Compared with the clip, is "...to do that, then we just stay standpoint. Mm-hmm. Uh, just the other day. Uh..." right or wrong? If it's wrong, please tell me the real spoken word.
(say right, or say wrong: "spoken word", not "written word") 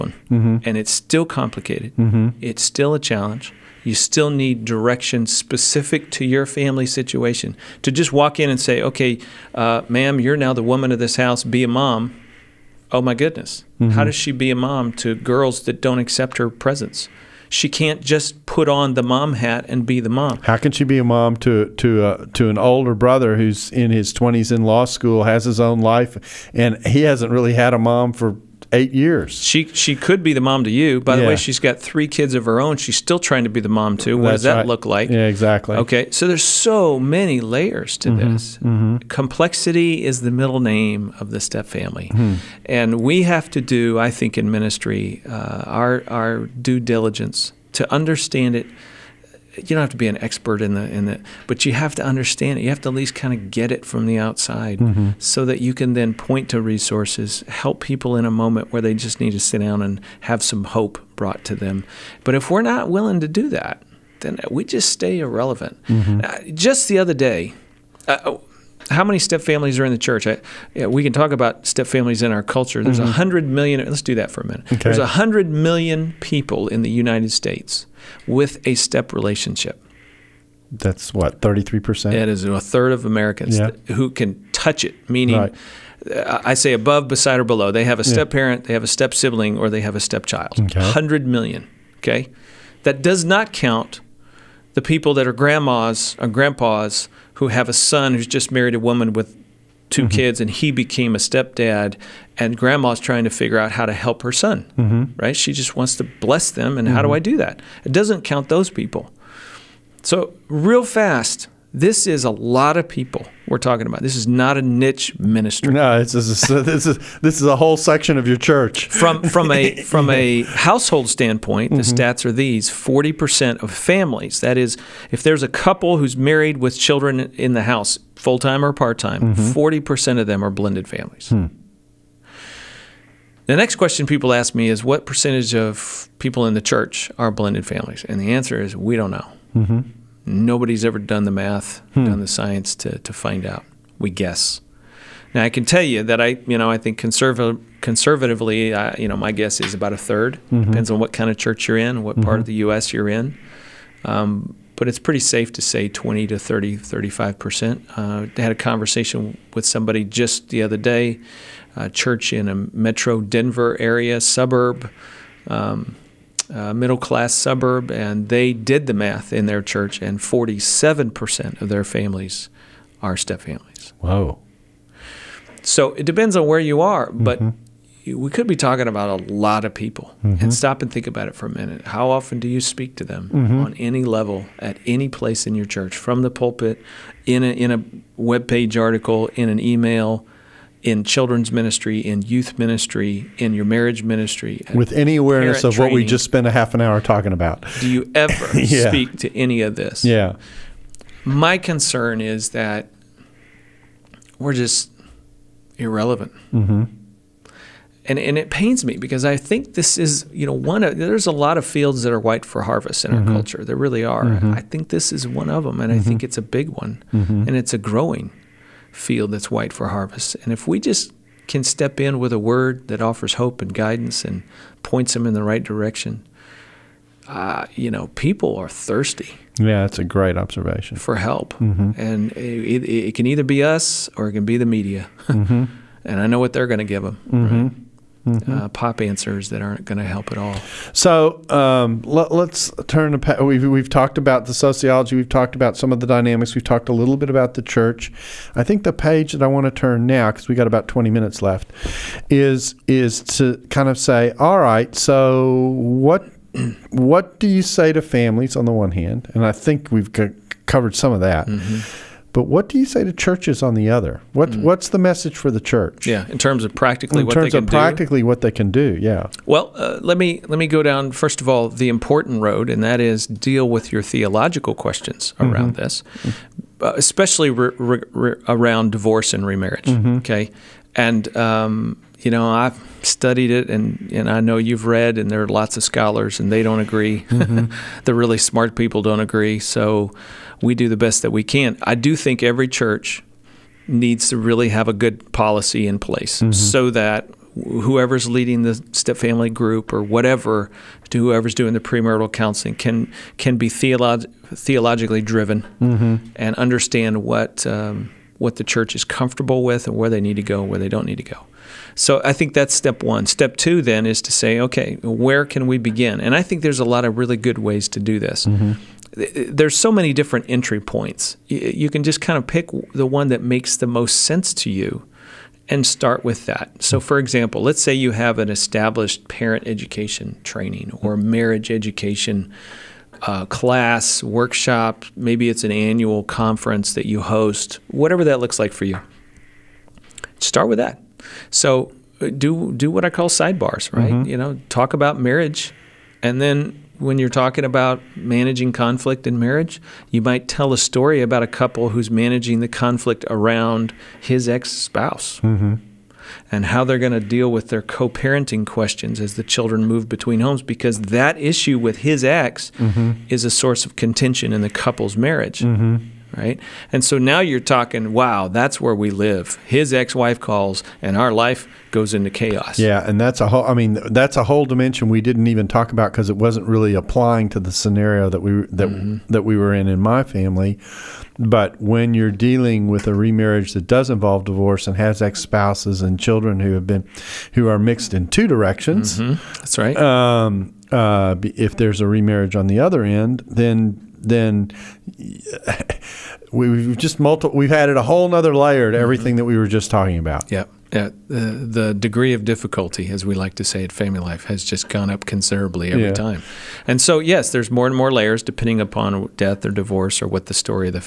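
wrong: "irrelevant", not "standpoint".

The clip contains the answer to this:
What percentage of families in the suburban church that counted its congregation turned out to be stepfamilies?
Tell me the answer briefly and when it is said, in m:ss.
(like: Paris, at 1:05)
47%, at 2:50.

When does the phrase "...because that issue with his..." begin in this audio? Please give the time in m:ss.
6:00.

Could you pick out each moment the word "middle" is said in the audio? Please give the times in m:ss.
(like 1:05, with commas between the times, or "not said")
0:40, 2:46.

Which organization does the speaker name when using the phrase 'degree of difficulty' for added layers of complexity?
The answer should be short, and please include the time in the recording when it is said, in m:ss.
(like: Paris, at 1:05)
Family Life, at 6:43.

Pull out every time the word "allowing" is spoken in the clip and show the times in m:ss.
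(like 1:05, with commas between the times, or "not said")
not said.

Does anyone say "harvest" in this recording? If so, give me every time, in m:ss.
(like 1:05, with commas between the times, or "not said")
3:32, 3:39.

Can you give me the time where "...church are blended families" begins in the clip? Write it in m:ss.
2:16.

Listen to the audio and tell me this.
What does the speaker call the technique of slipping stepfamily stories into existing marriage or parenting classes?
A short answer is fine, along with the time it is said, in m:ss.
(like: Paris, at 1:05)
sidebars, at 5:43.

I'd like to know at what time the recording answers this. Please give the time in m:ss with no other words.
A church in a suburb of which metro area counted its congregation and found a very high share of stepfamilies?
2:43.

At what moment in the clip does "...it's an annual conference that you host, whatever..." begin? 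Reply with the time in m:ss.
5:35.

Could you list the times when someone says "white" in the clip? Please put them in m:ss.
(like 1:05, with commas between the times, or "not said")
3:32, 3:39.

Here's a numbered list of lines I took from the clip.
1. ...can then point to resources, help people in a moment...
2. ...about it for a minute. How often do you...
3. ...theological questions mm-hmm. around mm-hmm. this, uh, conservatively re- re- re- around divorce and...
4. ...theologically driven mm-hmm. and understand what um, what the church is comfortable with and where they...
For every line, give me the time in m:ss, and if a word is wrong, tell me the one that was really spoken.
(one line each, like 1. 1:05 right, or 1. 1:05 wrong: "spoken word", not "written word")
1. 0:55 right
2. 3:01 right
3. 4:34 wrong: "especially", not "conservatively"
4. 5:04 right.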